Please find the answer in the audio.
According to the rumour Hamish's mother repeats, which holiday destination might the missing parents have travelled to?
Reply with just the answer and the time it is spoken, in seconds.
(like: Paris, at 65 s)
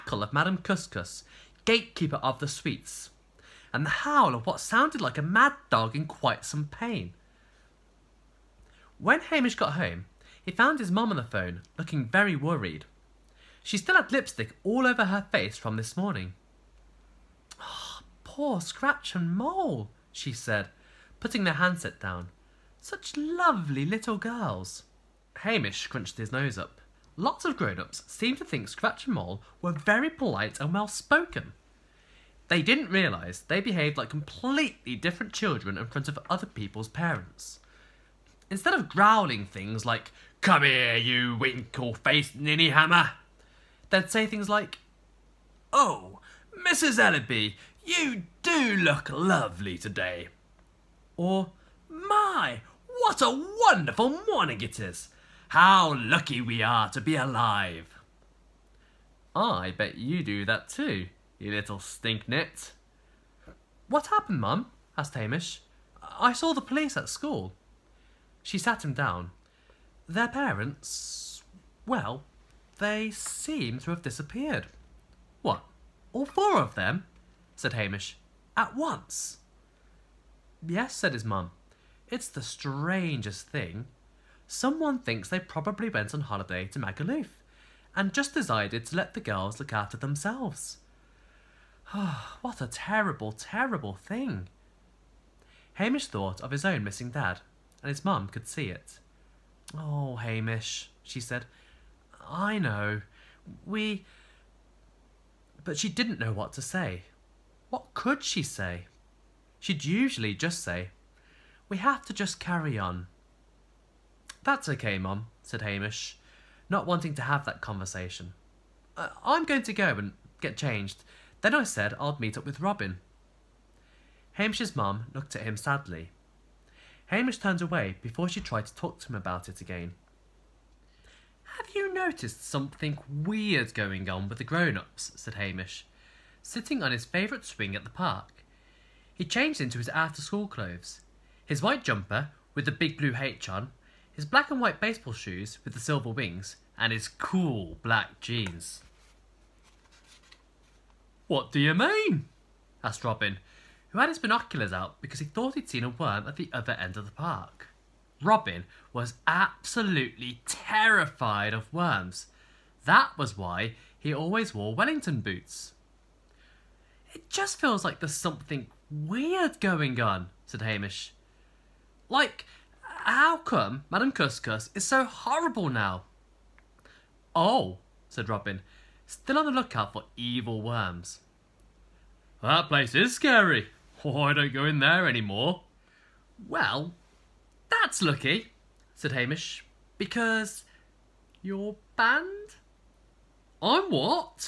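Magaluf, at 86 s.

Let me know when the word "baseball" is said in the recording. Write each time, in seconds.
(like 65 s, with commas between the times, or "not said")
144 s.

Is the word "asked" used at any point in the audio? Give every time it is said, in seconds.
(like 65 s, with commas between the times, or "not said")
64 s, 152 s.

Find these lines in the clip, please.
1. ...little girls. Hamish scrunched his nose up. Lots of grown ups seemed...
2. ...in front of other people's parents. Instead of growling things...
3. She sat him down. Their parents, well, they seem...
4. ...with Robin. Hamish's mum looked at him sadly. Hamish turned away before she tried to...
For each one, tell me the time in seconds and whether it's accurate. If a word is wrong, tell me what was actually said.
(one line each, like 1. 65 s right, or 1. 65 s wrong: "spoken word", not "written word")
1. 23 s right
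2. 35 s right
3. 68 s right
4. 122 s right.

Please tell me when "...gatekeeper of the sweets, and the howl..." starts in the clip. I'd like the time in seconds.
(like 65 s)
1 s.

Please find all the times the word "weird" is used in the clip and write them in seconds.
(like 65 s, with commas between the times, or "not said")
133 s, 168 s.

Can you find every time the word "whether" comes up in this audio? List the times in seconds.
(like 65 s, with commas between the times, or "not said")
not said.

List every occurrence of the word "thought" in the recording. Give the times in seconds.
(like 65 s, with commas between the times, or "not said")
96 s, 155 s.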